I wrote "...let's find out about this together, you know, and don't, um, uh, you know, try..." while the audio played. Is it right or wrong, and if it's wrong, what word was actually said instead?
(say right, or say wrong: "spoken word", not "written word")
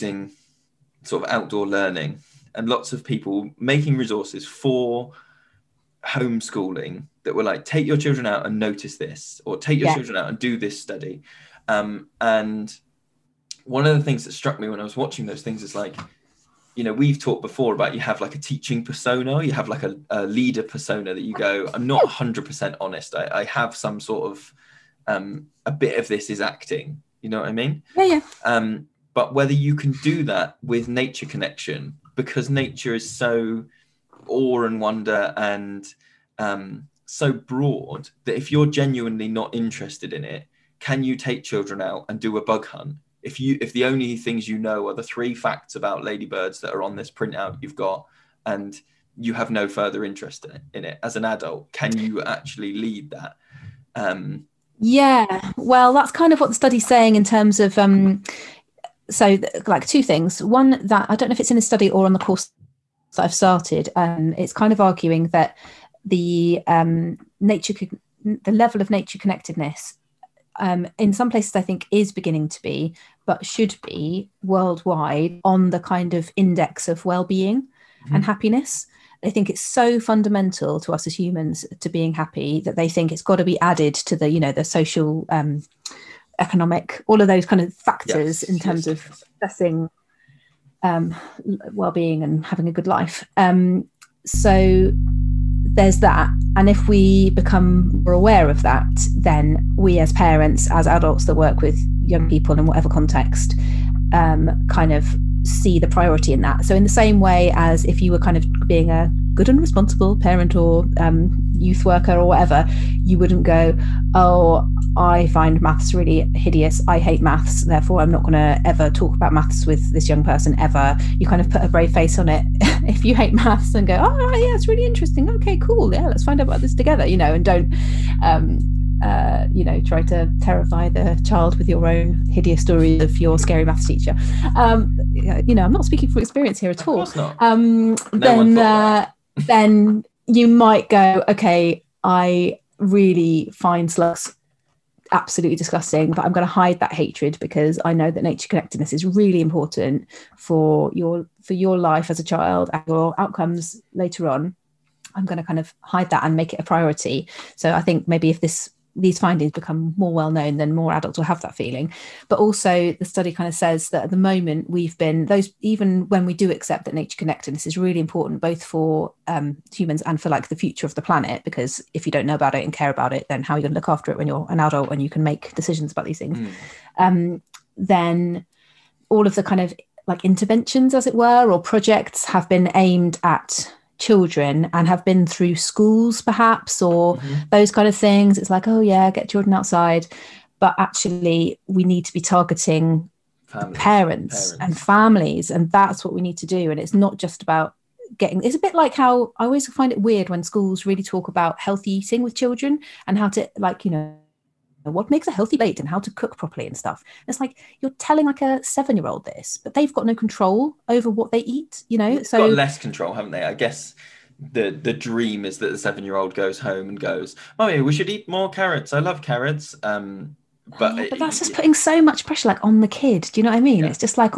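right.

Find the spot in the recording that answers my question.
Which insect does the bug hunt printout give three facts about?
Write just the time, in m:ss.
0:46.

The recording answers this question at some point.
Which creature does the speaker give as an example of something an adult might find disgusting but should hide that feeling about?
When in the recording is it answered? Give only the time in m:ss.
2:23.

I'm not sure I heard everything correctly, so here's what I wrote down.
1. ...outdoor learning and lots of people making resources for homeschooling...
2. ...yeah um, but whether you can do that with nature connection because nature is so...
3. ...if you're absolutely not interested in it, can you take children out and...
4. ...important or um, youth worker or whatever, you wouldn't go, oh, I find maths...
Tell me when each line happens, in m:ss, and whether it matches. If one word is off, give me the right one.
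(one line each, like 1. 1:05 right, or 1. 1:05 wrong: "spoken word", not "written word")
1. 0:01 right
2. 0:28 right
3. 0:38 wrong: "genuinely", not "absolutely"
4. 1:50 wrong: "parent", not "important".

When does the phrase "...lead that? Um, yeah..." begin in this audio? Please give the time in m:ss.
0:52.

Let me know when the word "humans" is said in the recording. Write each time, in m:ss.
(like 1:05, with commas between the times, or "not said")
1:21, 2:49.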